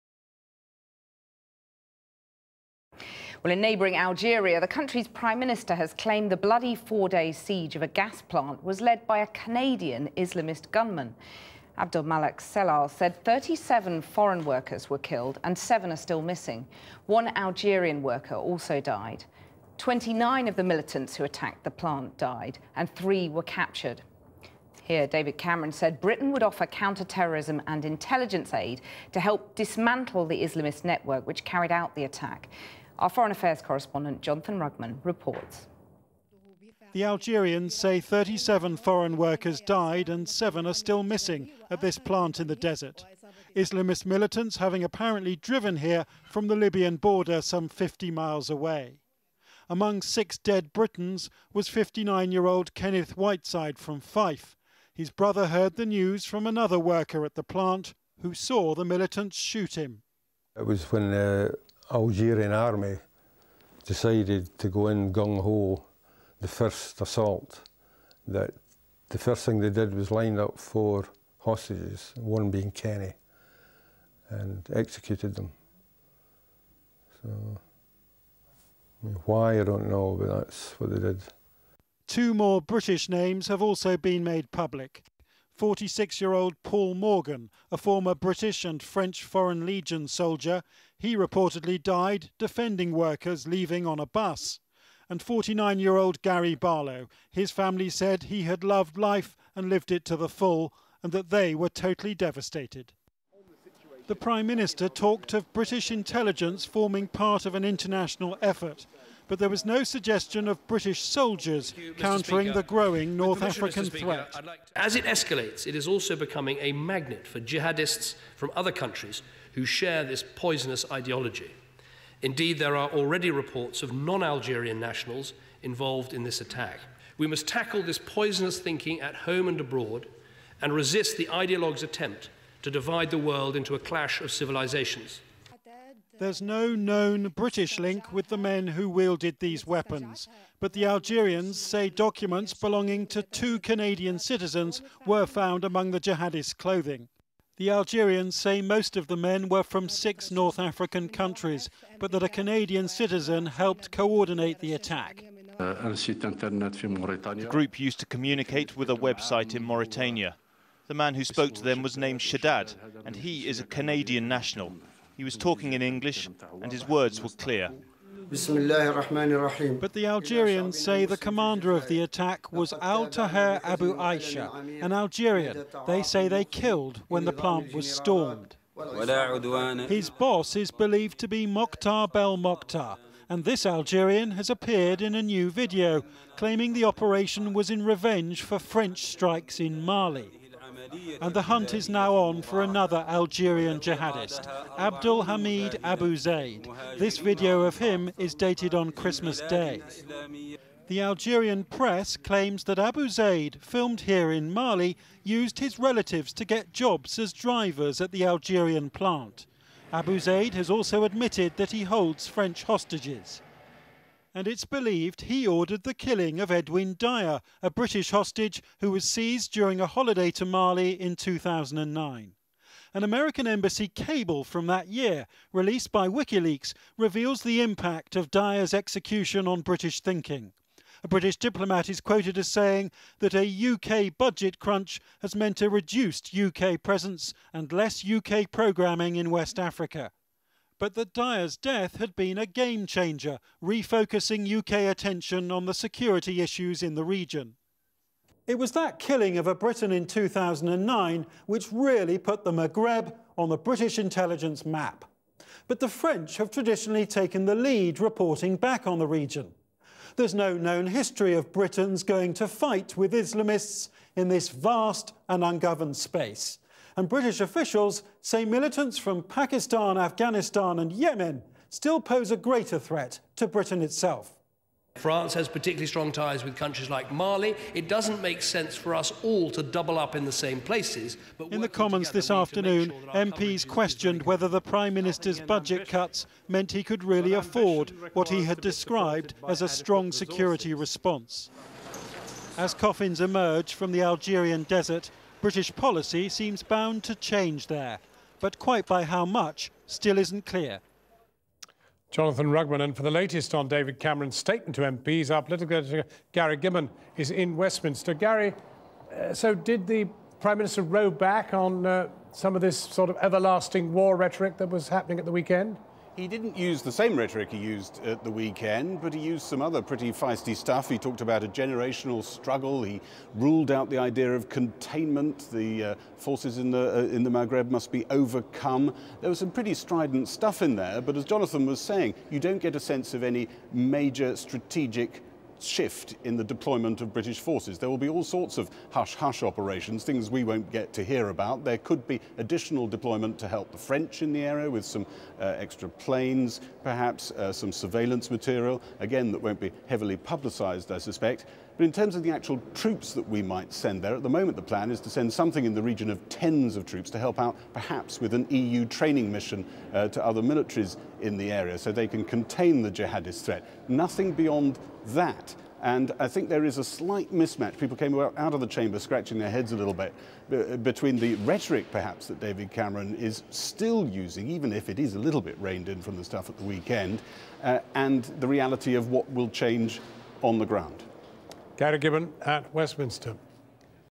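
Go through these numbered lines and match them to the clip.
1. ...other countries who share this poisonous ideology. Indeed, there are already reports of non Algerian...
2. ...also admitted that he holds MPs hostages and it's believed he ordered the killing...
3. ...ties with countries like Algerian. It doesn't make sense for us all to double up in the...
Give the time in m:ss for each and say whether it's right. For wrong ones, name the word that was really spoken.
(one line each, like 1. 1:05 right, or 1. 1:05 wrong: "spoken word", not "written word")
1. 1:58 right
2. 3:30 wrong: "French", not "MPs"
3. 4:36 wrong: "Mali", not "Algerian".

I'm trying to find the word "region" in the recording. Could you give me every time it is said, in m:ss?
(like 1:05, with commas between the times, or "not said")
4:07, 4:19, 5:55.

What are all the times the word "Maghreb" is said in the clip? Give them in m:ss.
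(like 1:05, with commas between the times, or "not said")
4:12, 5:27.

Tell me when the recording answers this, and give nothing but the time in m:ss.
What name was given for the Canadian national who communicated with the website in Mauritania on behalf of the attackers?
2:42.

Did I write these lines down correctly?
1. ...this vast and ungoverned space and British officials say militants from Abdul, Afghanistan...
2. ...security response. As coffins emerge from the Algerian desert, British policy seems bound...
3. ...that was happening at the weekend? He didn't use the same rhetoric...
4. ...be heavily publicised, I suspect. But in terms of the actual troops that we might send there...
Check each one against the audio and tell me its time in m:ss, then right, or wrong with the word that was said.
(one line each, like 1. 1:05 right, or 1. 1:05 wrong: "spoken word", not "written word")
1. 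4:24 wrong: "Pakistan", not "Abdul"
2. 4:50 right
3. 5:14 right
4. 5:49 right.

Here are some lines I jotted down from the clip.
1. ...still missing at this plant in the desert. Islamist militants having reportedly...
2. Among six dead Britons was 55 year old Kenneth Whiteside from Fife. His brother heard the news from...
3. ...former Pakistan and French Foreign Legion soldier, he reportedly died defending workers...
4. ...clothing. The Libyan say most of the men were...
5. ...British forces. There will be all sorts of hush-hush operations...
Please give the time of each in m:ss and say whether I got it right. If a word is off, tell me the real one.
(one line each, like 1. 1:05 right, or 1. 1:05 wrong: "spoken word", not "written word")
1. 0:40 wrong: "apparently", not "reportedly"
2. 0:49 wrong: "59", not "55"
3. 1:27 wrong: "British", not "Pakistan"
4. 2:26 wrong: "Algerians", not "Libyan"
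5. 5:37 right.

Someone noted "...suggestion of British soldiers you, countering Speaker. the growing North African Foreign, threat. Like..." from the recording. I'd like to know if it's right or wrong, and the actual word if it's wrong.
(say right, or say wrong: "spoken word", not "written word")
wrong: "Speaker", not "Foreign".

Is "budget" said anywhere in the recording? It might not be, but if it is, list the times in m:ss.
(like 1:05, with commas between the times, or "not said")
3:54, 4:45.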